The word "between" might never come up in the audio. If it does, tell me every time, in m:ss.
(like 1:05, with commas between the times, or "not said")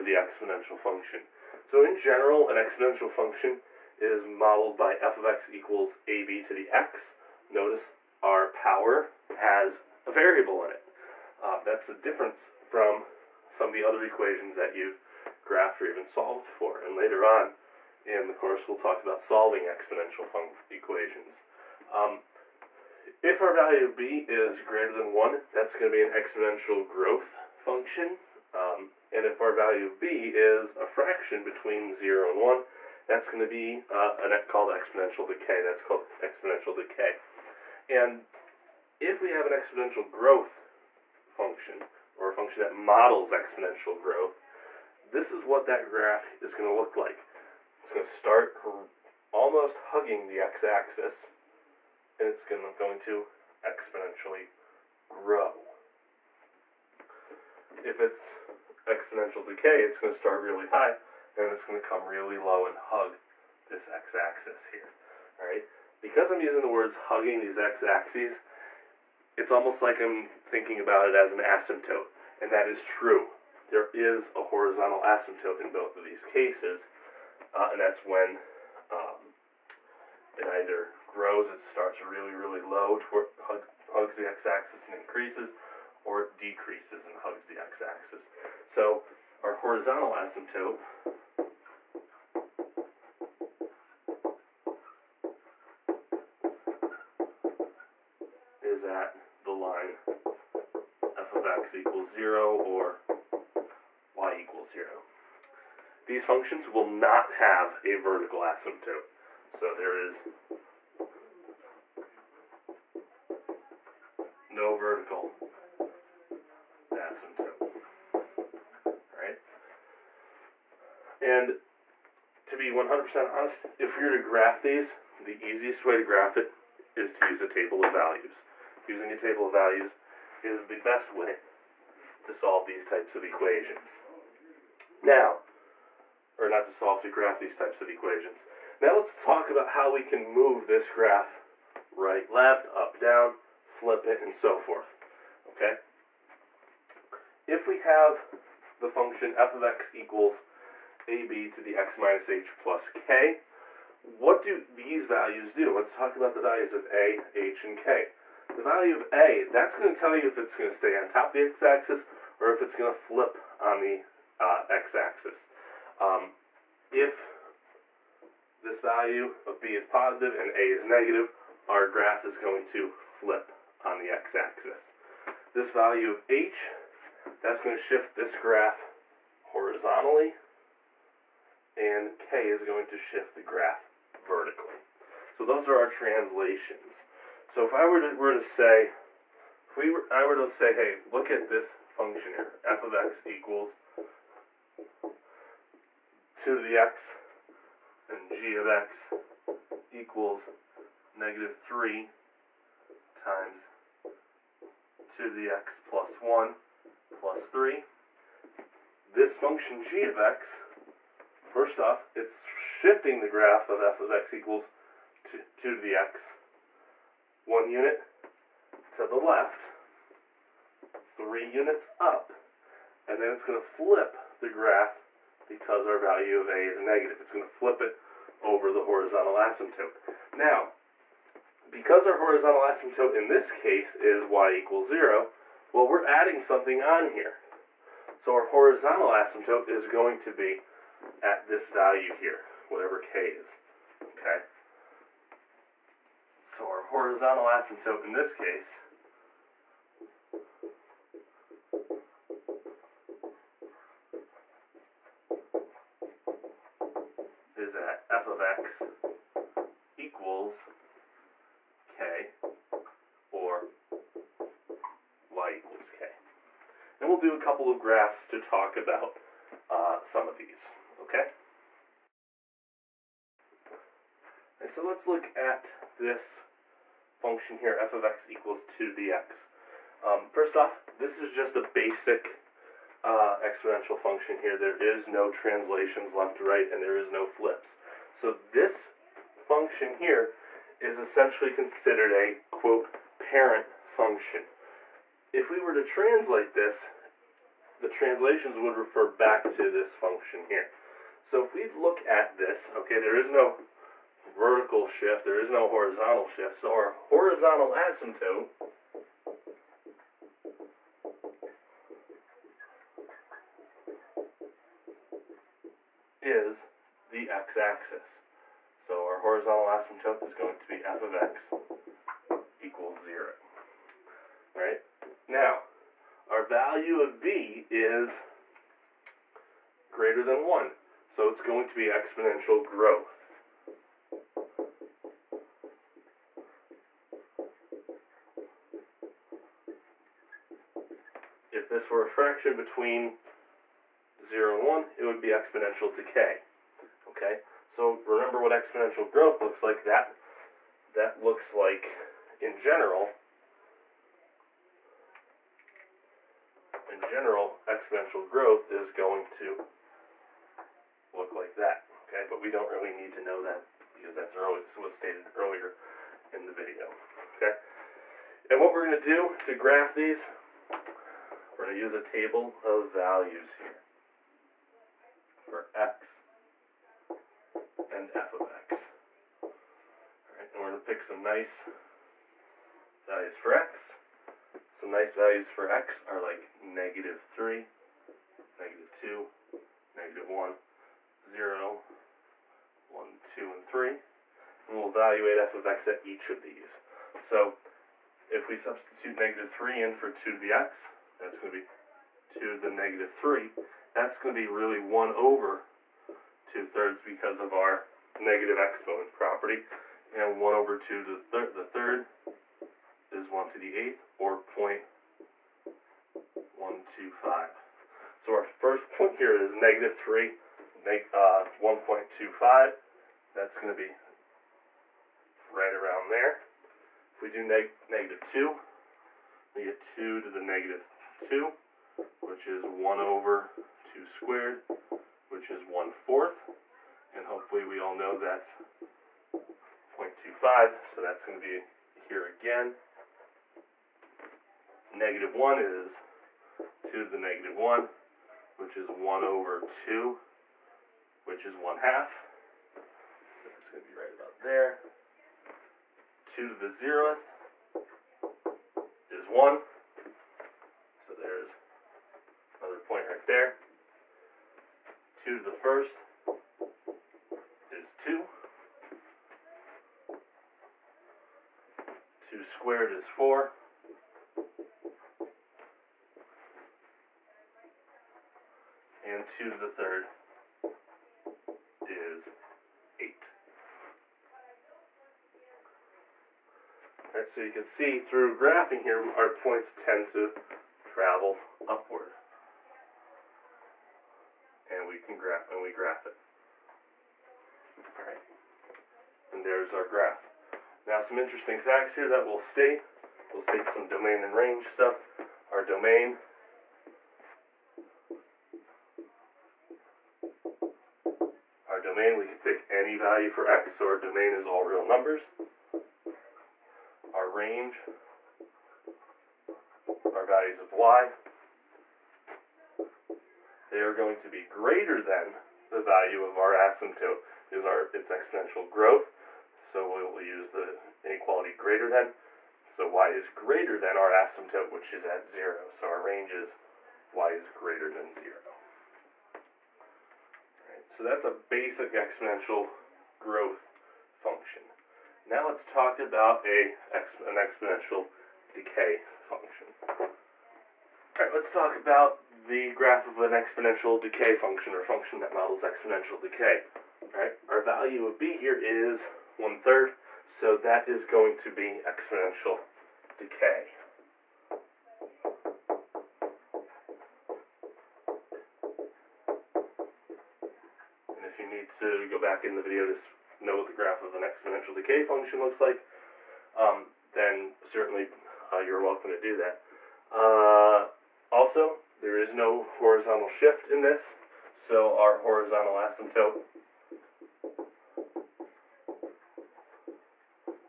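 0:31, 5:42.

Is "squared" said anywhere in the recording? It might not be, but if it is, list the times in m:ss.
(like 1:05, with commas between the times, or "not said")
7:14, 7:52.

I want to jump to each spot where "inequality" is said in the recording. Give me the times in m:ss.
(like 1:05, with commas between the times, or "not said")
8:51.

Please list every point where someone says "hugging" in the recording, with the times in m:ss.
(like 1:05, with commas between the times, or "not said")
0:49, 1:06.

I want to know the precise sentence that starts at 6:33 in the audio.
And we'll evaluate f of x at each of these.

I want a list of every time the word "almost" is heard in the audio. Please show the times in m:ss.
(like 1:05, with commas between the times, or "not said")
0:49, 1:09.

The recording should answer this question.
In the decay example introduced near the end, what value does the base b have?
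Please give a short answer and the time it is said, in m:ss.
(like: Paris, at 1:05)
one third, at 9:19.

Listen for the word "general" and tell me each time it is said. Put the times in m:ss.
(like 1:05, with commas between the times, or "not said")
0:01, 5:52, 5:57.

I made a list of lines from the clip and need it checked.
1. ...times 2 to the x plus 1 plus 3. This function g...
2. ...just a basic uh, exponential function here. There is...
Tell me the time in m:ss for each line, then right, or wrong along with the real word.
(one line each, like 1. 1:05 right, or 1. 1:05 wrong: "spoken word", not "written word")
1. 3:23 right
2. 4:41 right.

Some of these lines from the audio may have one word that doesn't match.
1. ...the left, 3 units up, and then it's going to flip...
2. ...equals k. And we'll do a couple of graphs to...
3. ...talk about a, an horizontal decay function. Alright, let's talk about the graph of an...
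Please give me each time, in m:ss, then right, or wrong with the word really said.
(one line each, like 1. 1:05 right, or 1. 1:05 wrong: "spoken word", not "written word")
1. 3:39 right
2. 4:25 right
3. 9:05 wrong: "exponential", not "horizontal".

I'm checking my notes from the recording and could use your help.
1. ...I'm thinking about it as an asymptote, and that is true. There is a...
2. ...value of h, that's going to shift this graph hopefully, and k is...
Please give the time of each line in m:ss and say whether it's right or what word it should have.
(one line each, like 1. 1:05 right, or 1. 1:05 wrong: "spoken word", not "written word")
1. 1:10 right
2. 2:55 wrong: "horizontally", not "hopefully".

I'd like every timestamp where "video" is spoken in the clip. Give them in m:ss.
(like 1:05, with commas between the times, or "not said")
6:06, 9:32.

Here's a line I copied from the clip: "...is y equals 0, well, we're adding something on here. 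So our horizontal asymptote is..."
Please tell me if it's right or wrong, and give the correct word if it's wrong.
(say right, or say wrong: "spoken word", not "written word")
right.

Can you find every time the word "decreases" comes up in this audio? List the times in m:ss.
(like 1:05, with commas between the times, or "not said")
1:26.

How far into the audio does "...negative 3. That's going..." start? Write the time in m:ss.
6:42.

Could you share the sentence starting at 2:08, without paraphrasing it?
Using a table of values is the best way to solve these types of equations.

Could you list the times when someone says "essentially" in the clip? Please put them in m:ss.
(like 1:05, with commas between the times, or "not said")
4:50.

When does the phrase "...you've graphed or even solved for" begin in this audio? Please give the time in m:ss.
0:14.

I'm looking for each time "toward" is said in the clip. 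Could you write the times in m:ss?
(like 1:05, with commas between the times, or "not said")
1:22.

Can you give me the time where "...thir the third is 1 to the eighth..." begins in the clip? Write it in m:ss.
6:51.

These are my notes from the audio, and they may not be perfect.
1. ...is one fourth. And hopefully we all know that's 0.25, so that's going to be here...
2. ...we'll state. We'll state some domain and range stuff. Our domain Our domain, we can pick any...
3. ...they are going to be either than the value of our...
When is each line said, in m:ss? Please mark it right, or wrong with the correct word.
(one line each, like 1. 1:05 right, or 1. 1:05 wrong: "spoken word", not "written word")
1. 7:15 right
2. 8:22 right
3. 8:43 wrong: "greater", not "either".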